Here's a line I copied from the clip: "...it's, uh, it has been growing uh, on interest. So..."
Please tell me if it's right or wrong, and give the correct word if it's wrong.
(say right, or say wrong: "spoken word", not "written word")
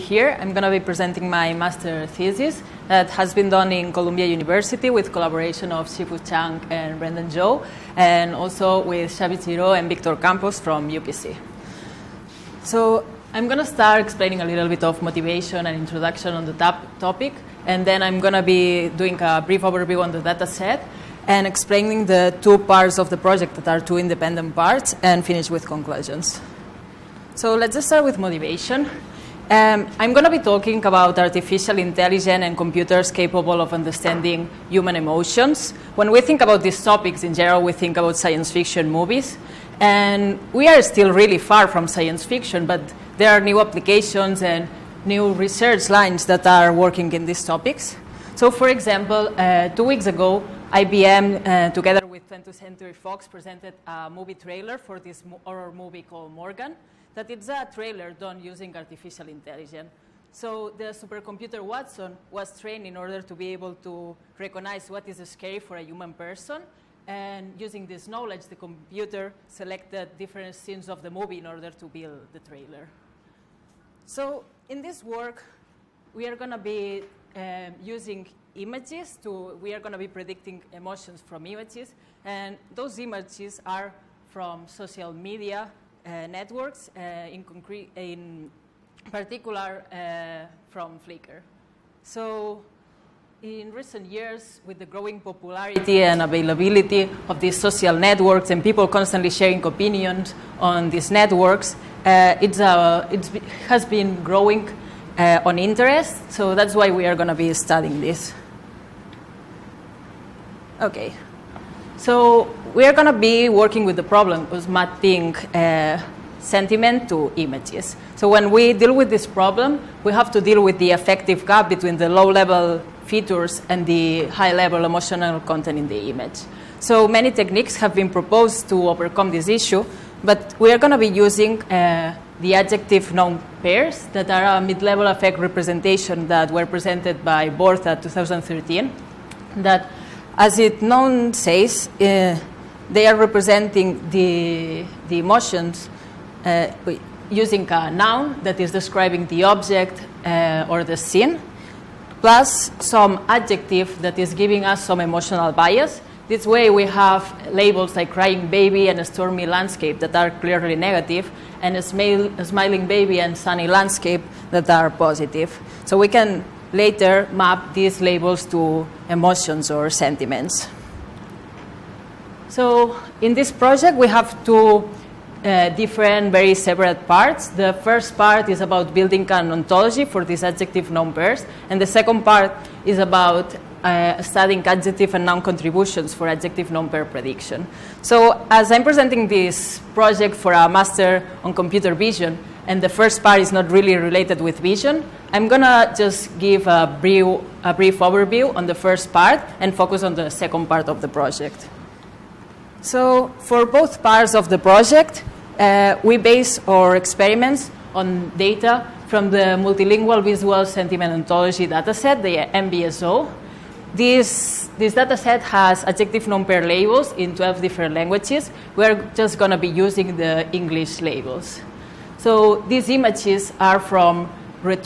right.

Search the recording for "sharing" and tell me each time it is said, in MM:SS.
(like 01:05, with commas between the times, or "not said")
01:39.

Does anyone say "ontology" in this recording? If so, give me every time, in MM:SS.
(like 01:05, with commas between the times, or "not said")
02:59, 03:31.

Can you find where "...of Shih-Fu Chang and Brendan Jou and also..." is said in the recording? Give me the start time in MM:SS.
00:05.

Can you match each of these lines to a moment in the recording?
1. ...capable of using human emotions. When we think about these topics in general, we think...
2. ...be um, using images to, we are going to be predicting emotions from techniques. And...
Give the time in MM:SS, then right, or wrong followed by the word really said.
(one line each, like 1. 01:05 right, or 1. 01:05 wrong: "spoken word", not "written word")
1. 00:33 wrong: "understanding", not "using"
2. 01:16 wrong: "images", not "techniques".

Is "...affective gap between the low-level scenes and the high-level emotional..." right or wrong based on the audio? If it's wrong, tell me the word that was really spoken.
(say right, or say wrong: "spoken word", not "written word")
wrong: "features", not "scenes".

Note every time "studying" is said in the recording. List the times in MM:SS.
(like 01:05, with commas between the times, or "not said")
01:47, 03:04.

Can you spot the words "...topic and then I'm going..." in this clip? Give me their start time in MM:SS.
00:16.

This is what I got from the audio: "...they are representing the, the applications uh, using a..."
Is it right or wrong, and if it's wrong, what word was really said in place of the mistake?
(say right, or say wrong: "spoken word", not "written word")
wrong: "emotions", not "applications".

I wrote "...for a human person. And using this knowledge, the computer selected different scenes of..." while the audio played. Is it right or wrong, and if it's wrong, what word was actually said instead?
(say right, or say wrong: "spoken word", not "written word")
right.